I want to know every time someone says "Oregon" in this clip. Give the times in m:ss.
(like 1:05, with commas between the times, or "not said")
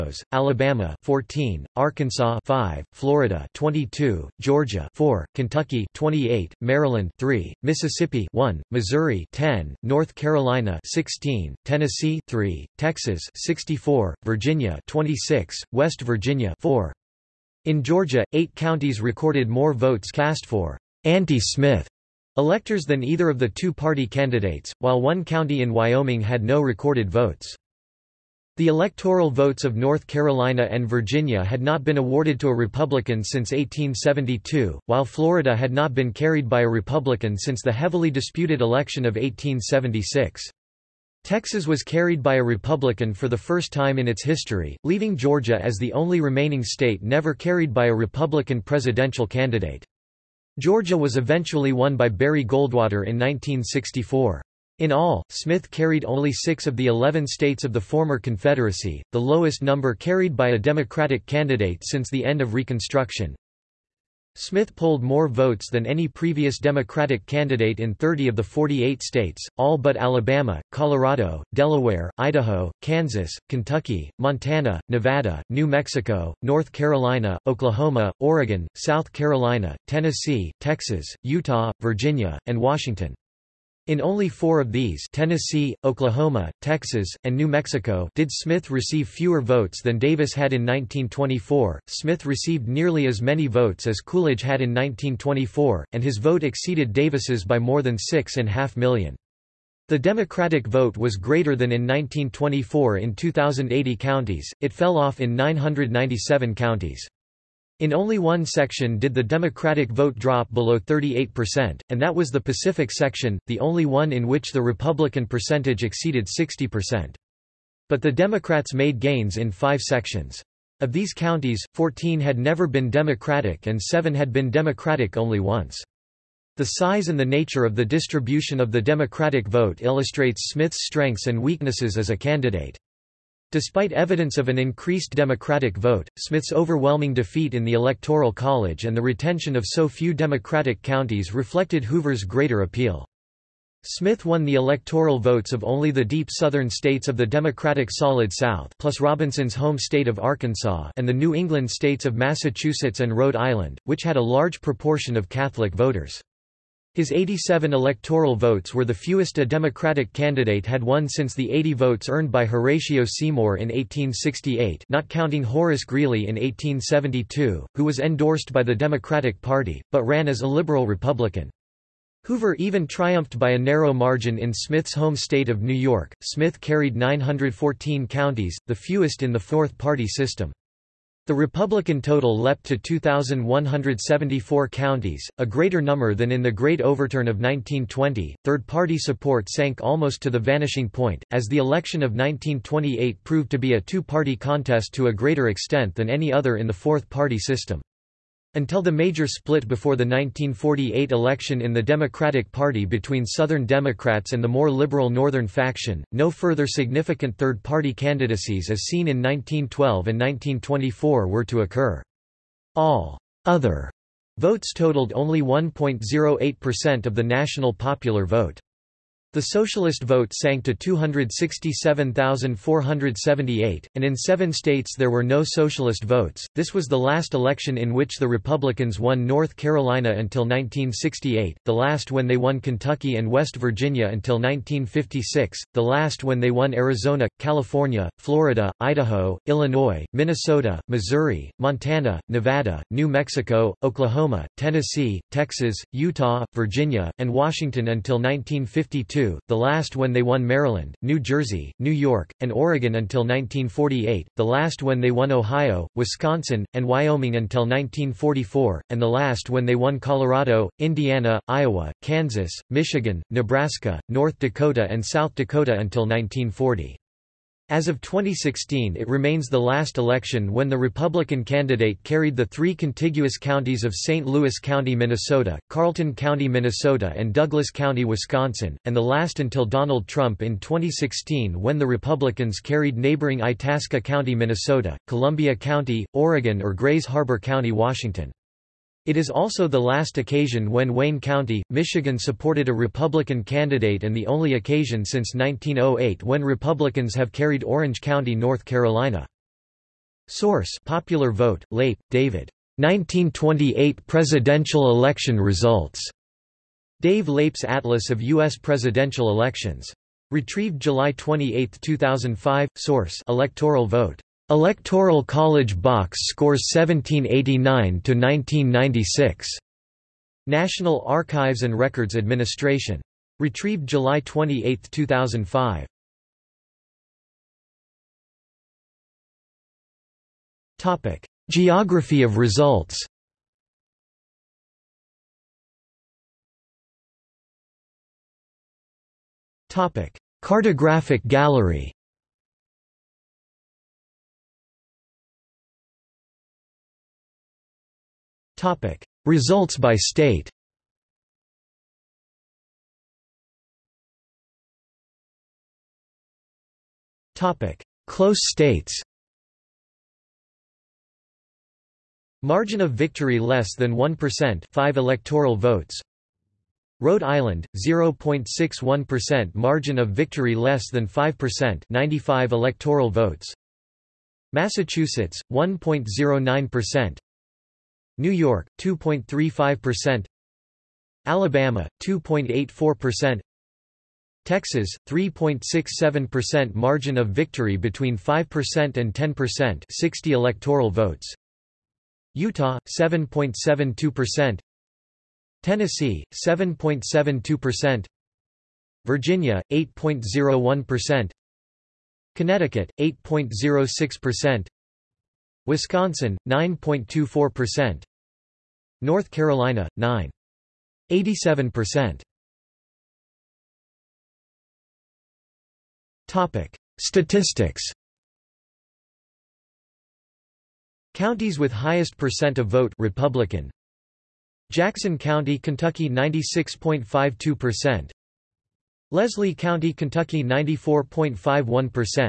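1:18, 4:12, 4:46.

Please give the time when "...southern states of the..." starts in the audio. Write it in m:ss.
2:26.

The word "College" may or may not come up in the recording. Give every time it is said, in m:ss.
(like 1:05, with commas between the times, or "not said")
2:18, 5:15.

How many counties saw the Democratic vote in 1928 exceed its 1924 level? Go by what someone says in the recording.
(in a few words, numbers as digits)
2,080.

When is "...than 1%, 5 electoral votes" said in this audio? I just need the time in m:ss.
6:03.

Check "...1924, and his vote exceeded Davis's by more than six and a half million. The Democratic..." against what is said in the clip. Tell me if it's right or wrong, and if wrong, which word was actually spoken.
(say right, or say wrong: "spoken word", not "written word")
right.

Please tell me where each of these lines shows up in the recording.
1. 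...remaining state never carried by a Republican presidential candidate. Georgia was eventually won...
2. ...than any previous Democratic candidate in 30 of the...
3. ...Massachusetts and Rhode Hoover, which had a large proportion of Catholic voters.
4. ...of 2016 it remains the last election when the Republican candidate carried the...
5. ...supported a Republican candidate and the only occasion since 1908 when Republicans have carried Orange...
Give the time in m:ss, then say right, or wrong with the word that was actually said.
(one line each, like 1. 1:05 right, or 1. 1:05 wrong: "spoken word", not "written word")
1. 0:46 right
2. 1:05 right
3. 2:32 wrong: "Island", not "Hoover"
4. 4:27 right
5. 4:52 right.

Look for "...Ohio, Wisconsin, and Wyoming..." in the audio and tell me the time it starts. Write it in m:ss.
4:15.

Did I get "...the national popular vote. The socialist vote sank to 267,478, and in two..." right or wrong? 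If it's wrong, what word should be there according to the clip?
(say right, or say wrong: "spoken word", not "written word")
wrong: "seven", not "two".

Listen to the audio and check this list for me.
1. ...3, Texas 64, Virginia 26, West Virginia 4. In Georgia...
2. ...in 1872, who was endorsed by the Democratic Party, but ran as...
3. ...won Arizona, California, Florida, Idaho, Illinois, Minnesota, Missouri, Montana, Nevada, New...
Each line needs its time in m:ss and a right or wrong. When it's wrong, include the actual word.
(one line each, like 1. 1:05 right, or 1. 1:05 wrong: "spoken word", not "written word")
1. 0:12 right
2. 2:46 right
3. 3:56 right.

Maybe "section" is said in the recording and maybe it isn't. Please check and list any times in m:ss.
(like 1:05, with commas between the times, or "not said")
1:48, 1:52, 1:59.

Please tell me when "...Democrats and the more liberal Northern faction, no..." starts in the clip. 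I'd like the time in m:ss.
3:23.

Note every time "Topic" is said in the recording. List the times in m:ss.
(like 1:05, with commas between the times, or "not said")
5:30, 5:39, 5:48, 5:57, 6:56.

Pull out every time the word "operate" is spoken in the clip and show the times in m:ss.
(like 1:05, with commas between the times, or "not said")
not said.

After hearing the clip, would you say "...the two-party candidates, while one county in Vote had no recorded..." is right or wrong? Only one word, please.
wrong.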